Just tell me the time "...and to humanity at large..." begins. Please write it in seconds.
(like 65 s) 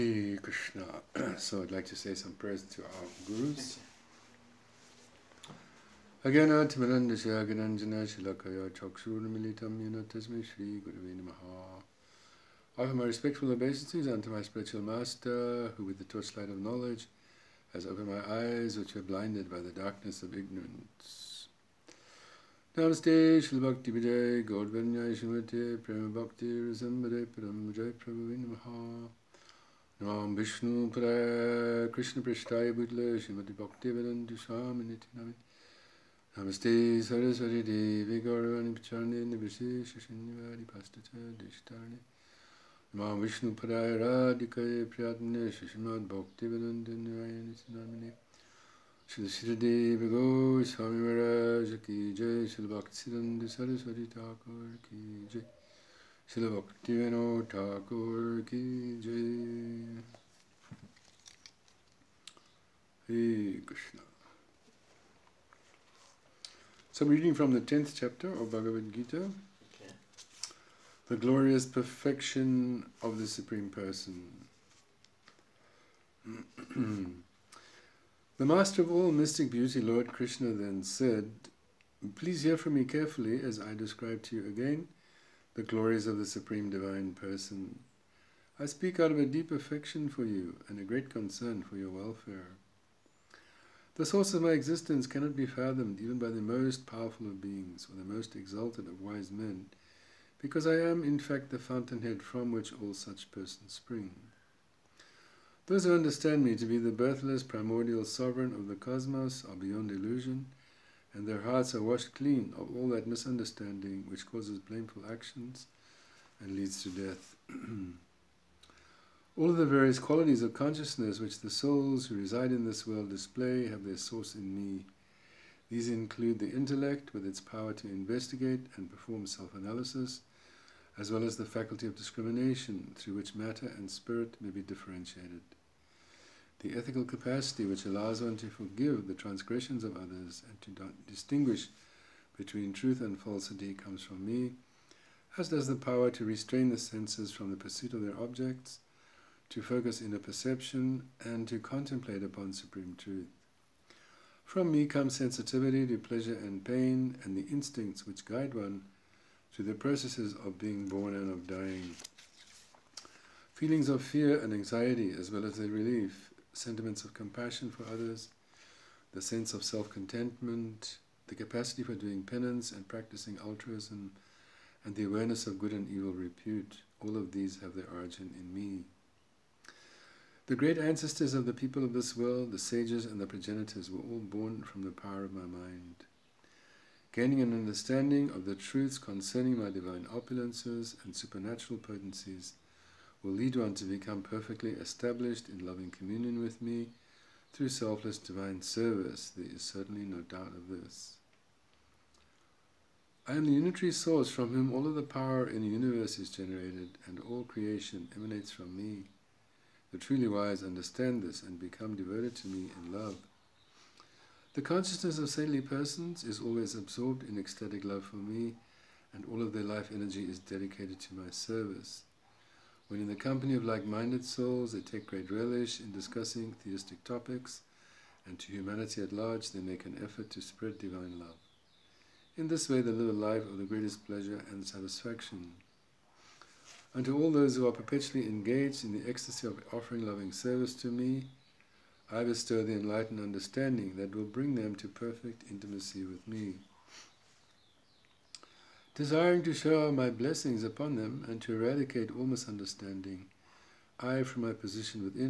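228 s.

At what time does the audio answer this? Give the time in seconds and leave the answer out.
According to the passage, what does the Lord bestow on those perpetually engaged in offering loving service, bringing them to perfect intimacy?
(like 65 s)
242 s.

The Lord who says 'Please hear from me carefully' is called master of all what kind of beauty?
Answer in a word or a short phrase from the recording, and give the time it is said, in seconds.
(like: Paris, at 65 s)
Mystic beauty, at 79 s.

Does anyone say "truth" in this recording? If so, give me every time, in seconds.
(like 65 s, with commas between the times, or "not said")
142 s, 152 s, 188 s.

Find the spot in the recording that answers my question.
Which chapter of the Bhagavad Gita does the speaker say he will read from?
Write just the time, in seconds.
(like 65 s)
67 s.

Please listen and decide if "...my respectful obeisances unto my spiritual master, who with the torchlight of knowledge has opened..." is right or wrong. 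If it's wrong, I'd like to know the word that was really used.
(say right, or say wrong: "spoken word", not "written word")
right.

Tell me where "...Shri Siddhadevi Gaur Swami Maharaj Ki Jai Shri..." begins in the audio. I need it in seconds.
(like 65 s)
49 s.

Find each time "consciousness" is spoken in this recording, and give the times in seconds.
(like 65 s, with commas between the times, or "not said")
120 s, 214 s.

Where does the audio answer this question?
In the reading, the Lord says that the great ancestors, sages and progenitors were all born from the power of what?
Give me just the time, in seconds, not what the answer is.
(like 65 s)
185 s.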